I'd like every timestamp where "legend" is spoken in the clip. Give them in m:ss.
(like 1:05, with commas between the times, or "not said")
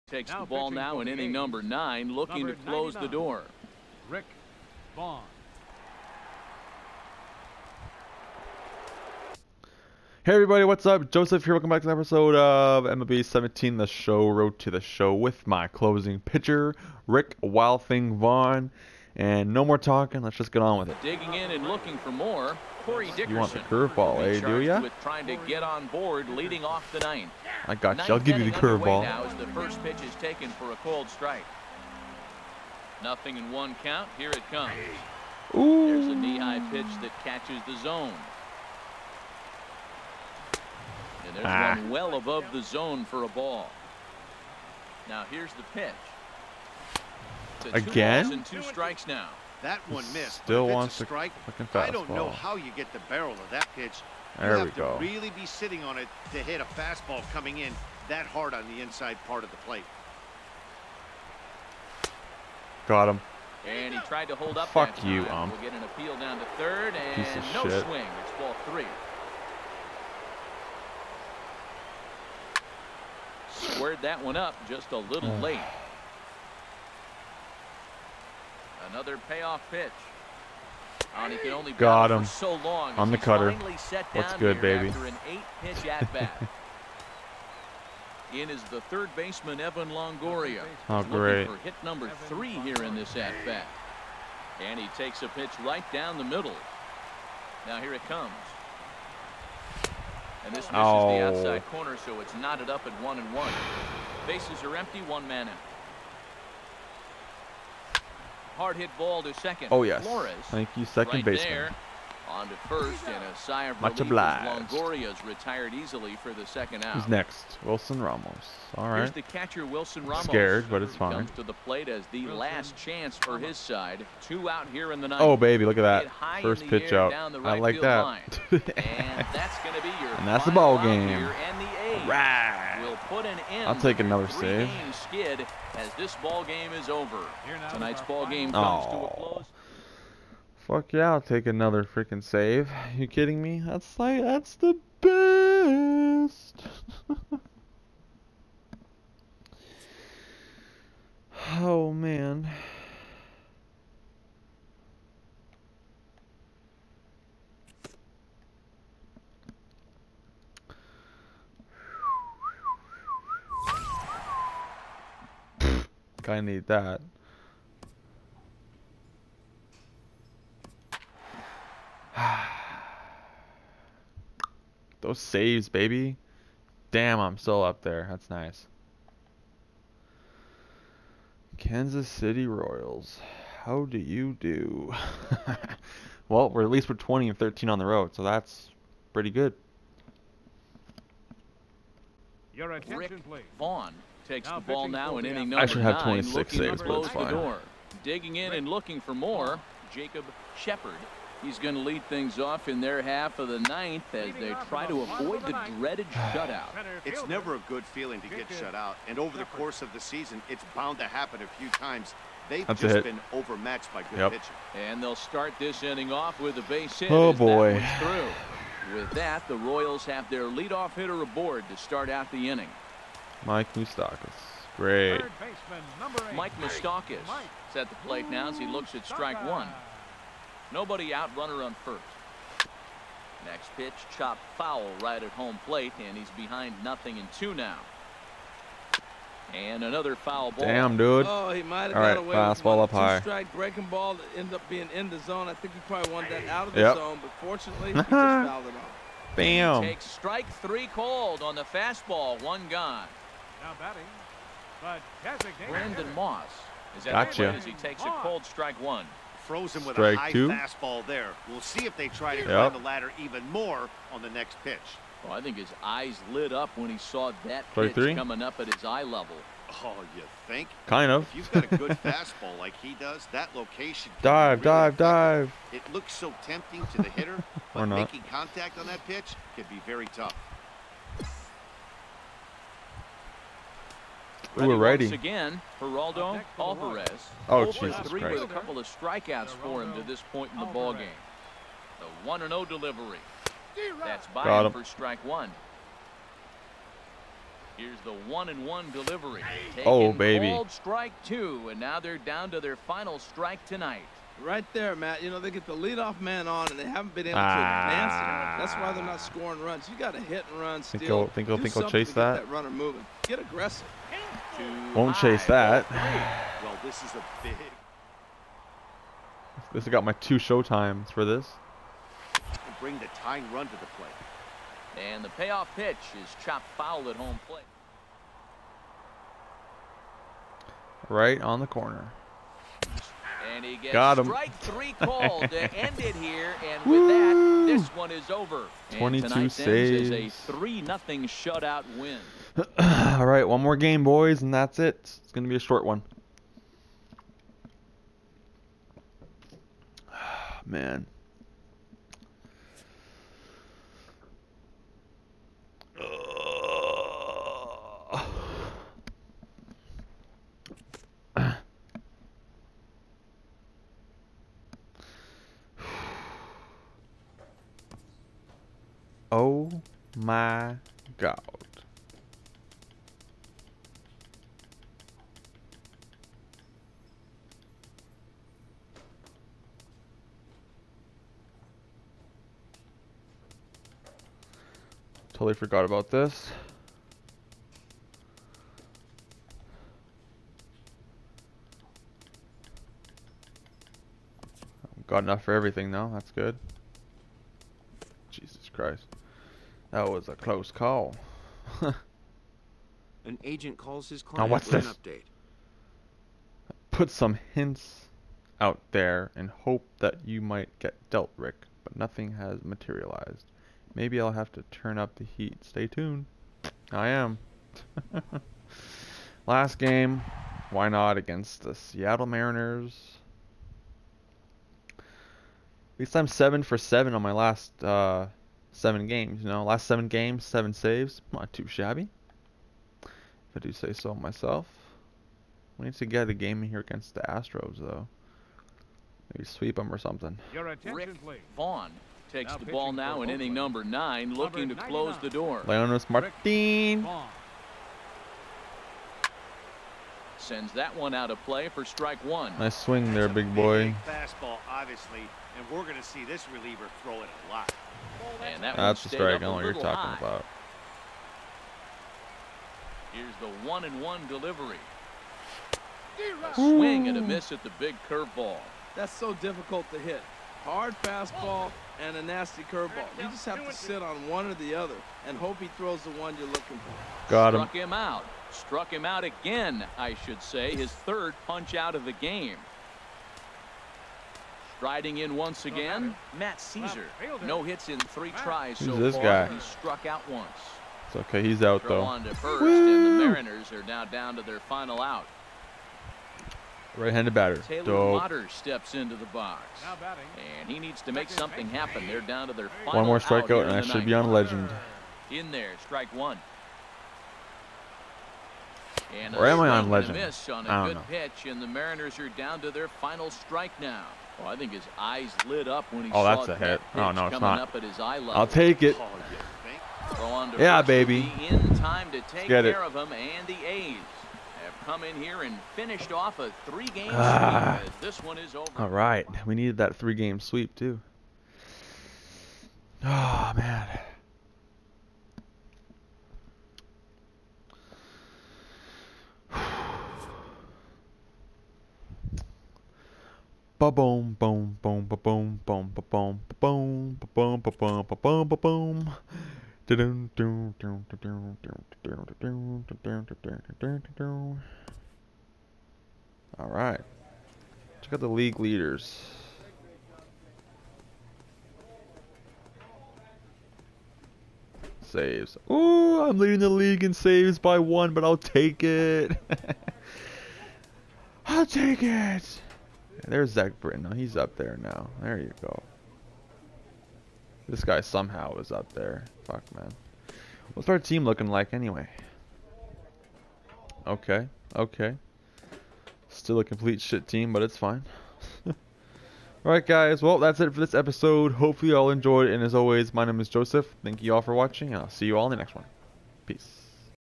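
8:24, 8:29.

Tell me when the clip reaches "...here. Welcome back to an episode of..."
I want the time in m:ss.
0:11.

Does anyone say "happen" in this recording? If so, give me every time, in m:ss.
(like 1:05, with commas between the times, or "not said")
3:31, 8:21.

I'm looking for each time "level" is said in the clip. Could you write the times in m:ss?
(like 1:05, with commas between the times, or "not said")
4:29, 8:38.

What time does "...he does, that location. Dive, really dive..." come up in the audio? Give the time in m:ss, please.
4:32.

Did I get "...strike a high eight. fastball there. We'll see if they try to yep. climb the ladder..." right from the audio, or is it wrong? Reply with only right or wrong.
wrong.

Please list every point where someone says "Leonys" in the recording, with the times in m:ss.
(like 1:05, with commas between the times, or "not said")
7:25.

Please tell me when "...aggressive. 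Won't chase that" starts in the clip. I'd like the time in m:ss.
5:13.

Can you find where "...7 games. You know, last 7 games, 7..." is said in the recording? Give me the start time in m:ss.
7:08.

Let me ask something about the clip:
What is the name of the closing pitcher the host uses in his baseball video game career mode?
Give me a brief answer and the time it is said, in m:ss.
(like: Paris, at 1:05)
Rick Vaughn, at 0:04.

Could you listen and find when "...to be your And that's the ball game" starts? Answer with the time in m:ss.
2:09.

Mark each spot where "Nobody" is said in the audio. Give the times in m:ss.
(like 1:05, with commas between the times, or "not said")
3:50.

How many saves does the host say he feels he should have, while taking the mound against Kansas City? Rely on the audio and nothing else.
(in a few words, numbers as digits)
26.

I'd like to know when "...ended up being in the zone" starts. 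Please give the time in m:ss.
4:04.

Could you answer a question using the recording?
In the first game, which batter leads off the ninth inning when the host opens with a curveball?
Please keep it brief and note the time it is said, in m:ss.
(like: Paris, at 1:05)
Corey Dickerson, at 0:22.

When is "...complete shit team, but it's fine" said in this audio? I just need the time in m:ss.
9:46.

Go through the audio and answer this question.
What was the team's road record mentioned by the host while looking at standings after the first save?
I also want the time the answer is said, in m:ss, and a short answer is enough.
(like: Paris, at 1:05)
20 and 13, at 3:06.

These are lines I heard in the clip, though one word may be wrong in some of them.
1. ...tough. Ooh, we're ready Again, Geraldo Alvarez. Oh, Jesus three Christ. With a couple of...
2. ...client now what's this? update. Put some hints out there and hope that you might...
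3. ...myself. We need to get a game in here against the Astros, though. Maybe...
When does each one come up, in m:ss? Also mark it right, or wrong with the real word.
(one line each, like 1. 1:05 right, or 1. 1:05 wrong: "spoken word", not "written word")
1. 4:40 right
2. 6:44 right
3. 7:14 right.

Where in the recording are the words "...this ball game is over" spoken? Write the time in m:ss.
2:15.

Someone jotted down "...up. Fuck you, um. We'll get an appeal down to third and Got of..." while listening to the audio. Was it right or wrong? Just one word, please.
wrong.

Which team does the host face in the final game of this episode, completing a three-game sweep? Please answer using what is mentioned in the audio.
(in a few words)
Seattle Mariners.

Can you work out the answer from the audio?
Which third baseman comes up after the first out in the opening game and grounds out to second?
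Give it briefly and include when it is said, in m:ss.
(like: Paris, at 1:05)
Evan Longoria, at 1:29.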